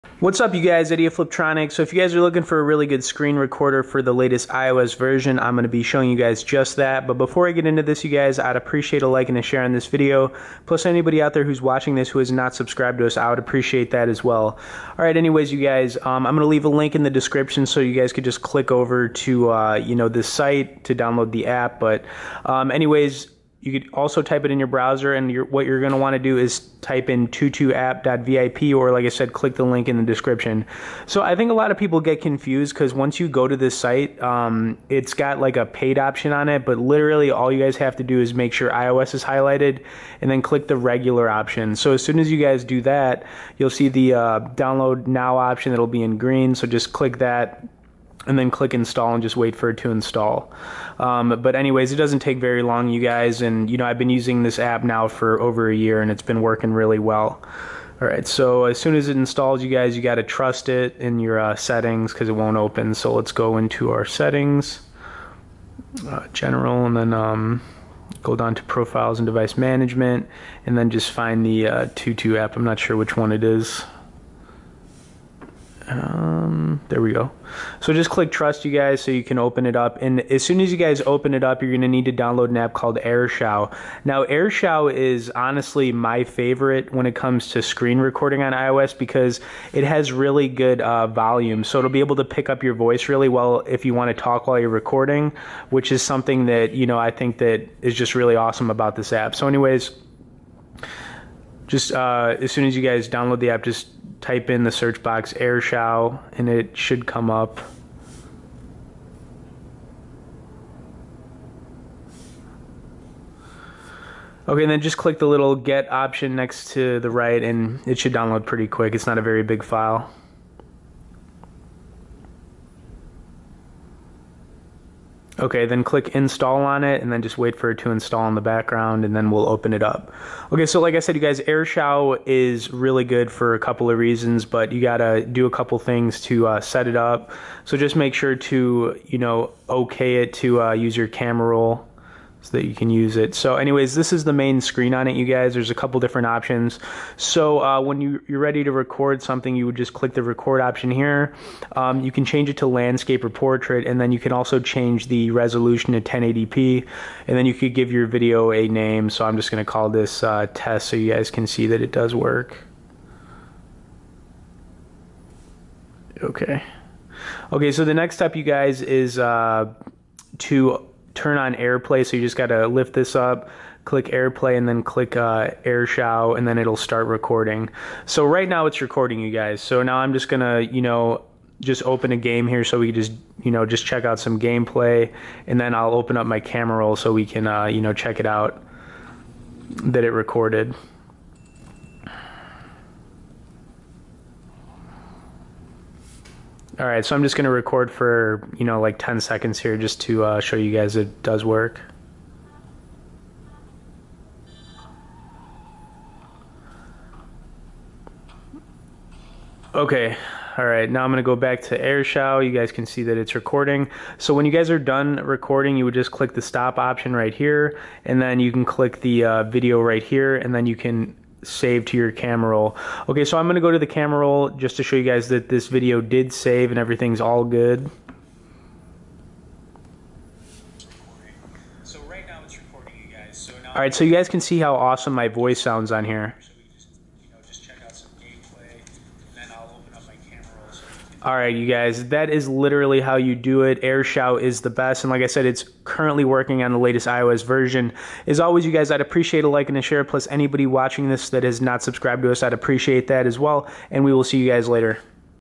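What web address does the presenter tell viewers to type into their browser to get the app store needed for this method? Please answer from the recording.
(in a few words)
tutuapp.vip.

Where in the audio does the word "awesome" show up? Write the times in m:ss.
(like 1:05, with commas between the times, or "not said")
1:38, 3:54.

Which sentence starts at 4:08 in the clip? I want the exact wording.
As always, you guys, I'd appreciate a like and a share.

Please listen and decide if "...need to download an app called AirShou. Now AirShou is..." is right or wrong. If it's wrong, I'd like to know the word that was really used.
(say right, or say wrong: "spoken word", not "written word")
right.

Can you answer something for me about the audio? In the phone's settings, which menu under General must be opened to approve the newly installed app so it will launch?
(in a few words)
profiles and device management.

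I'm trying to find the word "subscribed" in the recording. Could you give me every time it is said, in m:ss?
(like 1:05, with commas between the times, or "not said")
0:12, 4:11.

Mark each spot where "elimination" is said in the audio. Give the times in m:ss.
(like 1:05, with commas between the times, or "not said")
not said.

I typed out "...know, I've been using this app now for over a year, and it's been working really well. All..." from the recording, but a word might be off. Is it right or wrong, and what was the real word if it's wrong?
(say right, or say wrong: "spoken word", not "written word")
right.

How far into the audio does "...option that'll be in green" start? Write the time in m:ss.
0:45.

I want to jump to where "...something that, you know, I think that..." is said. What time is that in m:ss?
1:36.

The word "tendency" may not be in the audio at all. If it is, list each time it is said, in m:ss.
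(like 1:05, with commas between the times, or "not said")
not said.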